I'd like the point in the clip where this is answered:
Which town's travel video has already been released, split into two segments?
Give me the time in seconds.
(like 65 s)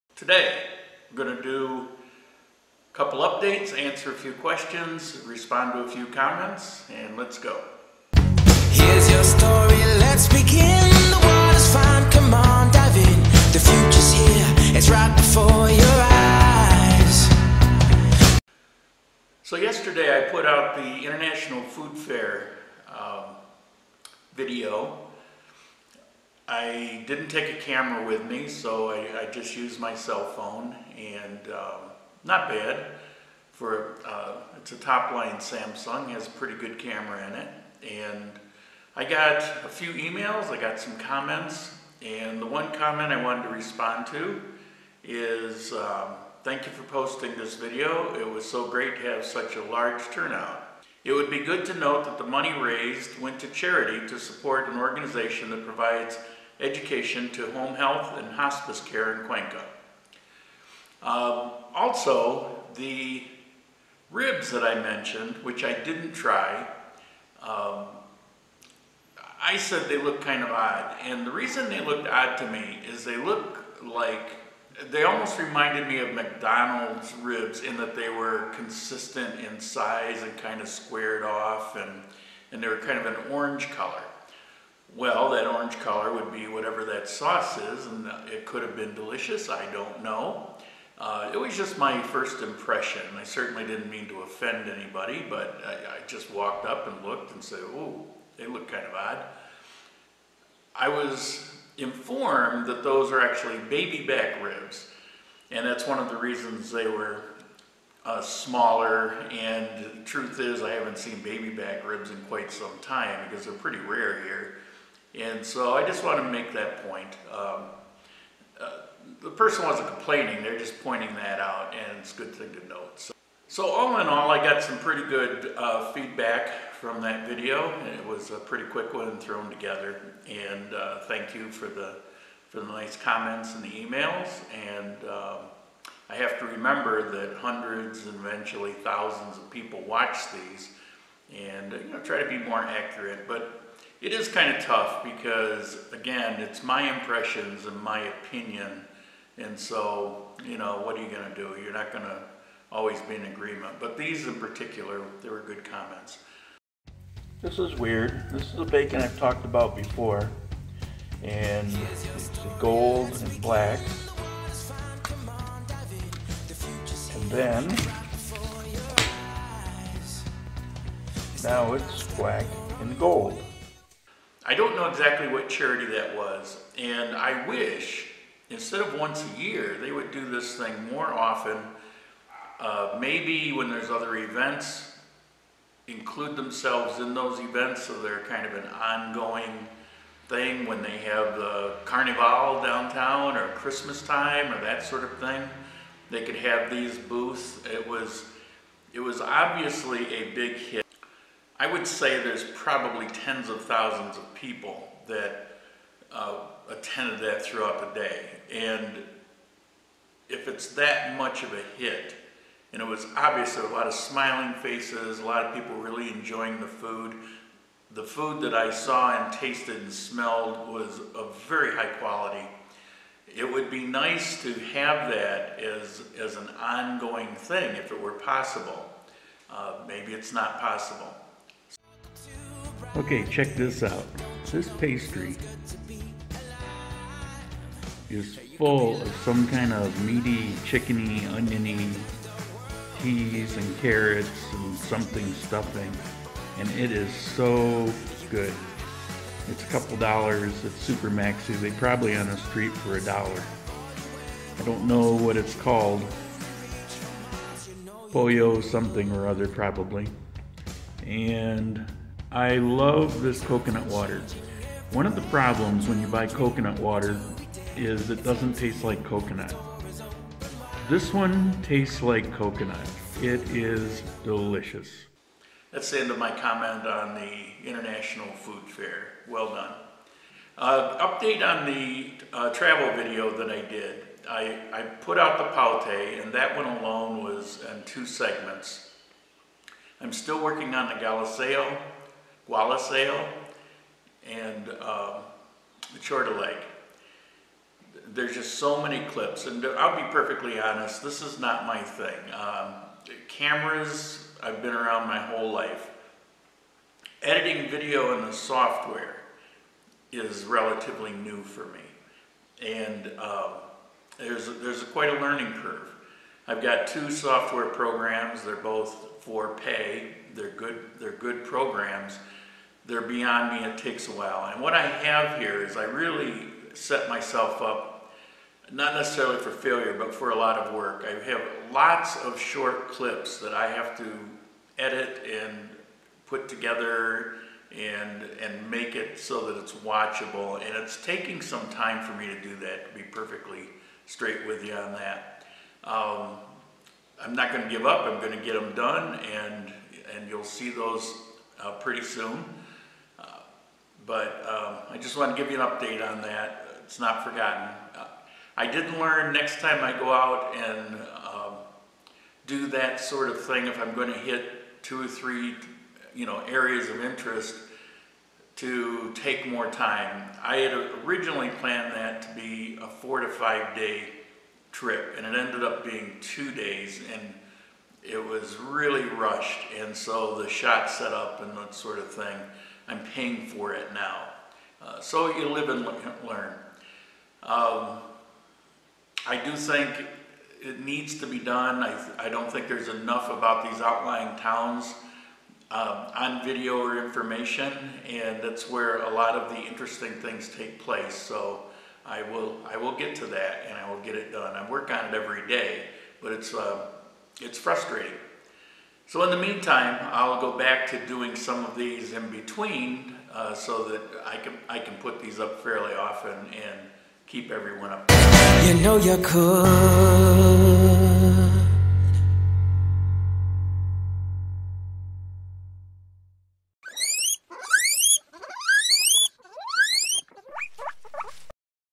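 285 s.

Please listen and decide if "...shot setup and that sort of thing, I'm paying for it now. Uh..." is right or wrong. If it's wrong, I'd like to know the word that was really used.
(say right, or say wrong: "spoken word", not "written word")
right.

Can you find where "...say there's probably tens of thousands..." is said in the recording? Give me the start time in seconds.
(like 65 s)
201 s.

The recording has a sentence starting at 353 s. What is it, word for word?
Uh, but um, I just want to give you an update on that.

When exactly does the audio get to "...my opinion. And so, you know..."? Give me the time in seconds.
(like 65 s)
147 s.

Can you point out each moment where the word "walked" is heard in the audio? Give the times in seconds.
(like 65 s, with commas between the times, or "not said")
96 s.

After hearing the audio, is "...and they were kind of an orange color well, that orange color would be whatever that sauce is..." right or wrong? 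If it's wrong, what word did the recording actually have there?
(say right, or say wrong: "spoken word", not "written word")
right.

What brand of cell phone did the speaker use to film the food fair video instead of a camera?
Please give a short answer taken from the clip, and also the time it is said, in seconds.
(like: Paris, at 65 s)
Samsung, at 35 s.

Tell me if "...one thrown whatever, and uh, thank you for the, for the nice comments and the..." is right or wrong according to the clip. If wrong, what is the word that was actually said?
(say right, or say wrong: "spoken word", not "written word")
wrong: "together", not "whatever".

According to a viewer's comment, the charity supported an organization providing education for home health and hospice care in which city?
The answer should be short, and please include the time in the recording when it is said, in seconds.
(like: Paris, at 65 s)
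Cuenca, at 59 s.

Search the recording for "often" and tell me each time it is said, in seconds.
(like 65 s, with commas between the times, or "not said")
181 s, 415 s.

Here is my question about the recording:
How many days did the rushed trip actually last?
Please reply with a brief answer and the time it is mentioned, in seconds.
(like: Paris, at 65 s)
2 days, at 376 s.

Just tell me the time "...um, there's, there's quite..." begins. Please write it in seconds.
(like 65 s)
313 s.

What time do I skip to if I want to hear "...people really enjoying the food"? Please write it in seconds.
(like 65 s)
215 s.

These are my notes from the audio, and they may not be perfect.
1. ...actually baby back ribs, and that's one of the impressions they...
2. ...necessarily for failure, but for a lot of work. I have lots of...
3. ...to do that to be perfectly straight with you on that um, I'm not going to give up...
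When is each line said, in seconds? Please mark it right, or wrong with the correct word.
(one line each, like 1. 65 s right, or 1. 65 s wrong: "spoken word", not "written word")
1. 103 s wrong: "reasons", not "impressions"
2. 328 s right
3. 342 s right.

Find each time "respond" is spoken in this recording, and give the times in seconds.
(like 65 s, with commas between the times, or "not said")
5 s, 43 s.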